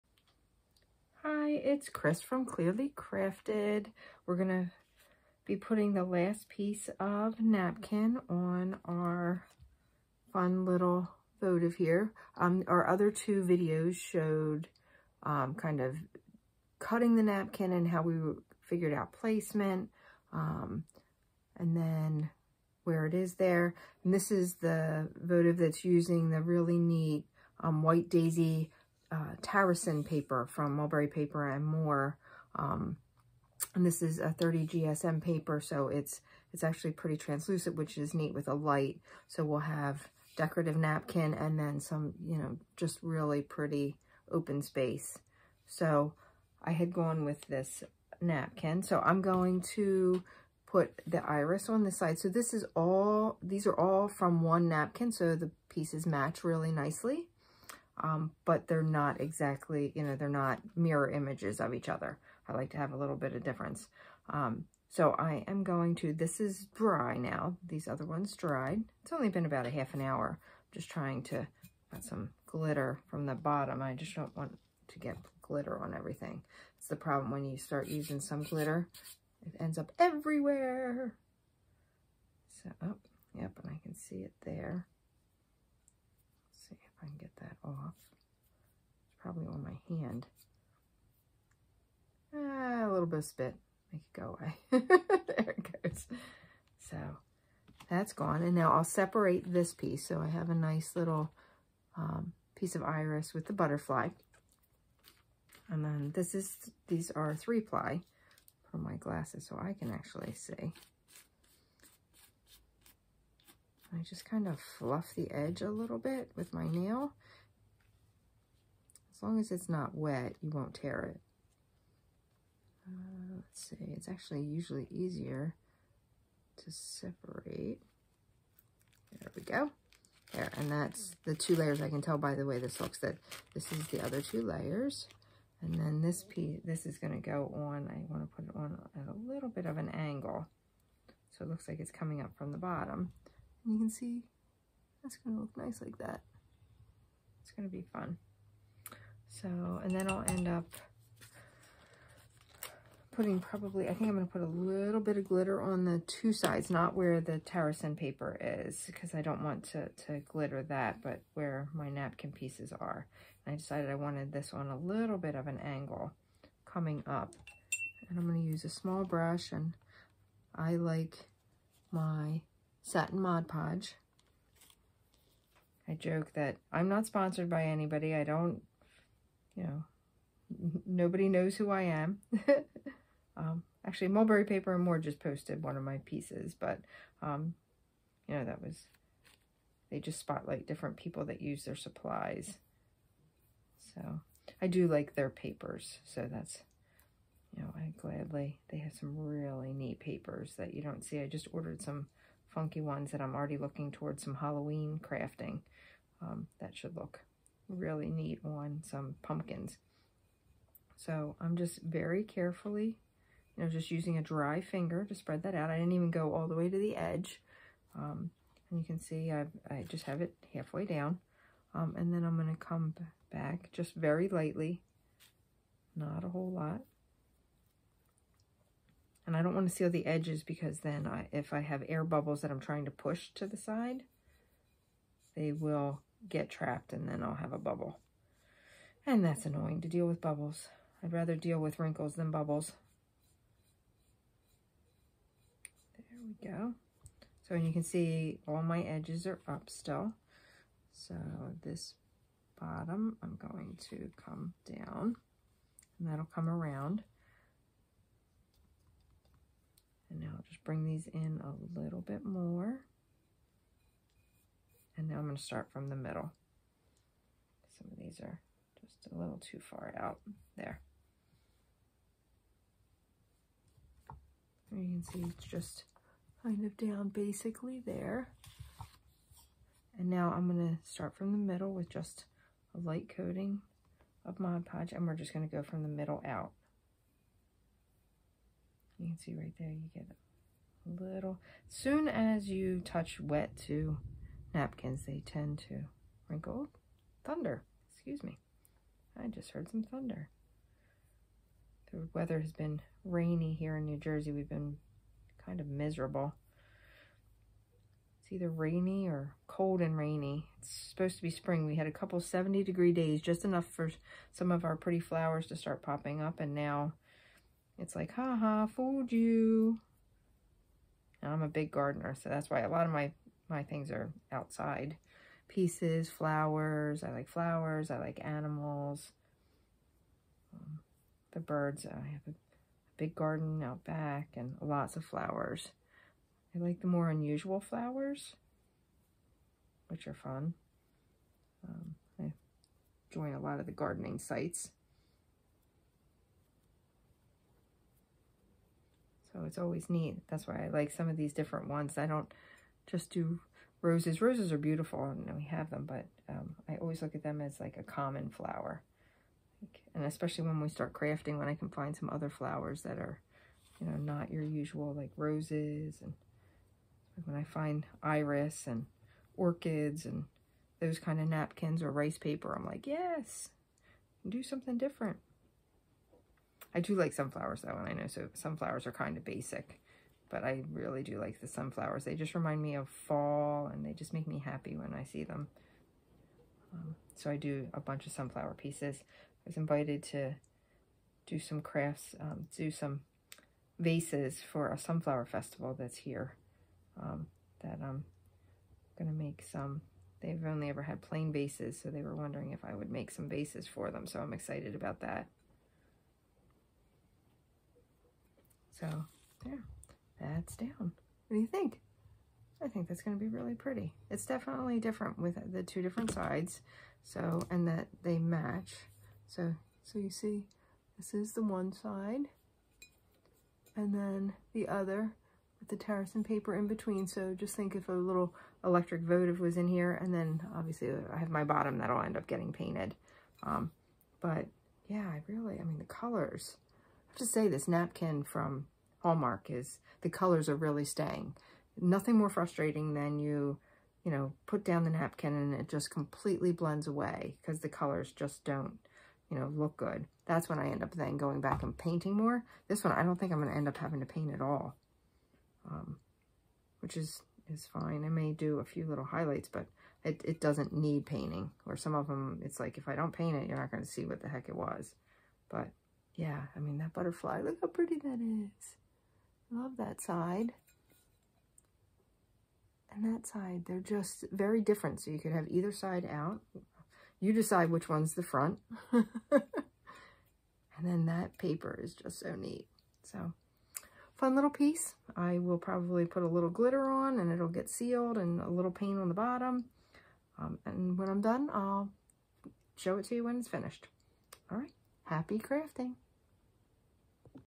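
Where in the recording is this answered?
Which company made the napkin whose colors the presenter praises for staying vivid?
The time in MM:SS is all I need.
07:18.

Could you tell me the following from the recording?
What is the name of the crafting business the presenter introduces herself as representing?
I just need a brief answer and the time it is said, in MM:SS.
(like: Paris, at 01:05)
Klearly Krafted, at 00:02.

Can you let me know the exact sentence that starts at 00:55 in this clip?
So the pieces match really nicely um, but they're not exactly, you know, they're not mirror images of each other.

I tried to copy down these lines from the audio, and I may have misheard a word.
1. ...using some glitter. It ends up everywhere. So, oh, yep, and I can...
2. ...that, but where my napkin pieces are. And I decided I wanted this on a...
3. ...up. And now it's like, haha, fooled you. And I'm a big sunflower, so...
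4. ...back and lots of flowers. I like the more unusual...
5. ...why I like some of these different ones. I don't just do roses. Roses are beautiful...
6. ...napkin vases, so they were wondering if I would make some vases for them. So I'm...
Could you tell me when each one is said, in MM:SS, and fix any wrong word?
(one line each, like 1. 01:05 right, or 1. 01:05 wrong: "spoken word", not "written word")
1. 01:17 right
2. 02:40 right
3. 05:16 wrong: "gardener", not "sunflower"
4. 05:33 right
5. 05:50 right
6. 06:41 wrong: "plain", not "napkin".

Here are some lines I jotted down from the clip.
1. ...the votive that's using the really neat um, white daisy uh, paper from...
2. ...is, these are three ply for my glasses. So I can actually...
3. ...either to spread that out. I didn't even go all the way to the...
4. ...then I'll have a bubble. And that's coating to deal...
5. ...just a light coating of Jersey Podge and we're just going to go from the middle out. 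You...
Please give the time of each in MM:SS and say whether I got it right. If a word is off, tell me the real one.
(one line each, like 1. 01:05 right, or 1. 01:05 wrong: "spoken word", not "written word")
1. 00:24 right
2. 01:46 right
3. 03:34 wrong: "finger", not "either"
4. 03:57 wrong: "annoying", not "coating"
5. 04:41 wrong: "Mod", not "Jersey".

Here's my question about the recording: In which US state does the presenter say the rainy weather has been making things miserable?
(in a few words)
New Jersey.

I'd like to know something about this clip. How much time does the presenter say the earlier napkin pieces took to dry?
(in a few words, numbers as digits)
half an hour.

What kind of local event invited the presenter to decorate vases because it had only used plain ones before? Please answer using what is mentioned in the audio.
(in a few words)
sunflower festival.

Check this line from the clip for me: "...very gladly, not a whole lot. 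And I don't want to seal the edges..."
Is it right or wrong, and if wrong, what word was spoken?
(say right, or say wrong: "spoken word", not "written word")
wrong: "lightly", not "gladly".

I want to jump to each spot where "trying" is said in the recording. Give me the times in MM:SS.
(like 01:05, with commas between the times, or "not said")
01:10, 03:52.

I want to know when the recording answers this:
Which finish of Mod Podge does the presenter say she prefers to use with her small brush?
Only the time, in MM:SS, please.
02:52.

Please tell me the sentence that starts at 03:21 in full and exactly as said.
I just ordered some funky ones that I'm already looking towards some Halloween crafting.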